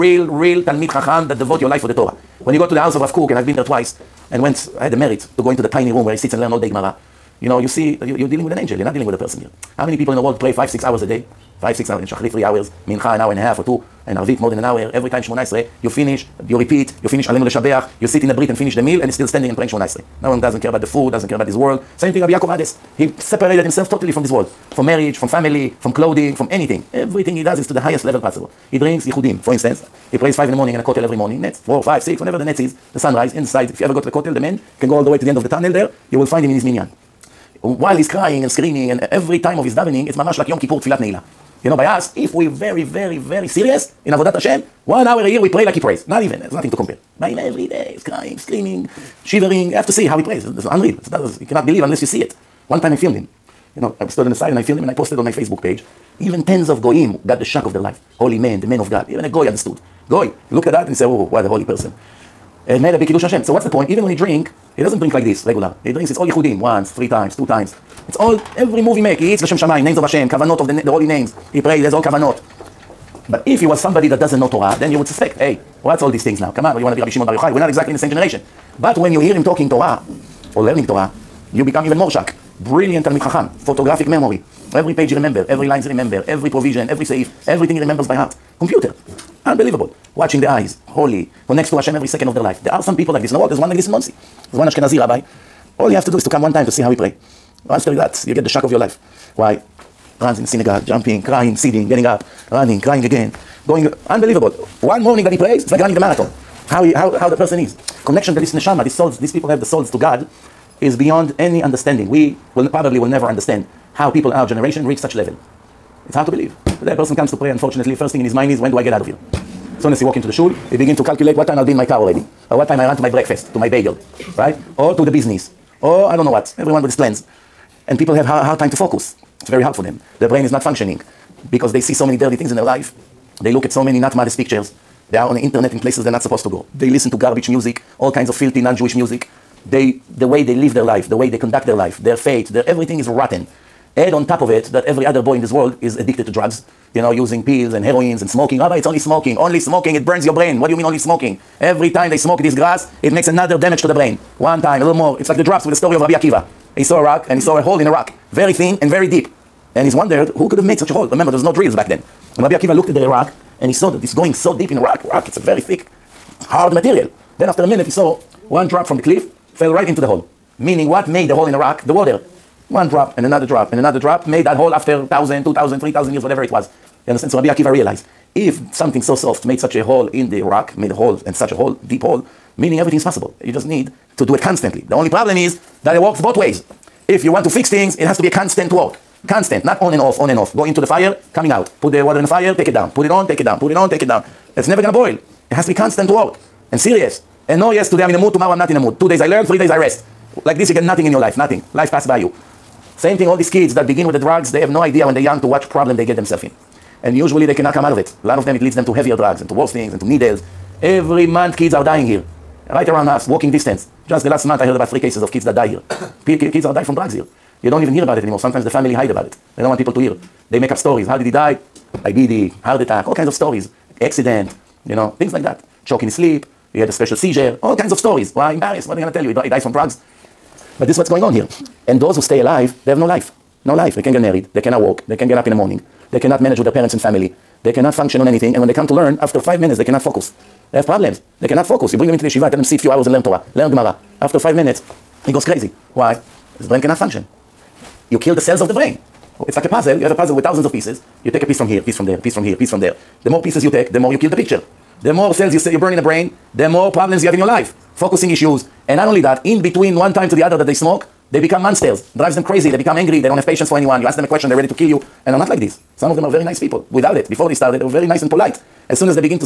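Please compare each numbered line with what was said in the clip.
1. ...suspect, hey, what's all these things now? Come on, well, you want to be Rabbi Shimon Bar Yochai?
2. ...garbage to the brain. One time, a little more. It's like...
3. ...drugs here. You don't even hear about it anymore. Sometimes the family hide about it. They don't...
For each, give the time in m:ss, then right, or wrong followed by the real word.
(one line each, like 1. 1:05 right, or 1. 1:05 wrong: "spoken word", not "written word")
1. 1:15 right
2. 2:33 wrong: "damage", not "garbage"
3. 3:36 right.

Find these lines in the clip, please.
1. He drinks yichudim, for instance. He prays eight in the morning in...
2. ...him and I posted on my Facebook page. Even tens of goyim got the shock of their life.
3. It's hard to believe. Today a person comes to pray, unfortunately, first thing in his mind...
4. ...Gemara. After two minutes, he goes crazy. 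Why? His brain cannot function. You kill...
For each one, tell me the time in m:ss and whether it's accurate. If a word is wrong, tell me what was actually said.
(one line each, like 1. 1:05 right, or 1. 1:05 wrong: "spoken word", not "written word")
1. 0:28 wrong: "five", not "eight"
2. 0:54 right
3. 1:56 right
4. 4:03 wrong: "five", not "two".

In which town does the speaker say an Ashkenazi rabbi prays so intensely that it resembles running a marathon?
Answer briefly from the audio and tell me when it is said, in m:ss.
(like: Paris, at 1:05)
Monsey, at 1:33.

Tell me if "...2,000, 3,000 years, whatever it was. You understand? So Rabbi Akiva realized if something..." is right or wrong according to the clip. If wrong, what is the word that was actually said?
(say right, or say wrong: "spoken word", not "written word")
right.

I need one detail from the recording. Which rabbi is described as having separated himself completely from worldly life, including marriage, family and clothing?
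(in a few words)
Rabbi Yaakov Ades.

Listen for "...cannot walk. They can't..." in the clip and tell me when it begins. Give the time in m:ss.
3:54.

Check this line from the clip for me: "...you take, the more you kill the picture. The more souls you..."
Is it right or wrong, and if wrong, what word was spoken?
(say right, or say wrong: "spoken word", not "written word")
wrong: "cells", not "souls".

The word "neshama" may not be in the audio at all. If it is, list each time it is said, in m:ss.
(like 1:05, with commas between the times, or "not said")
1:48.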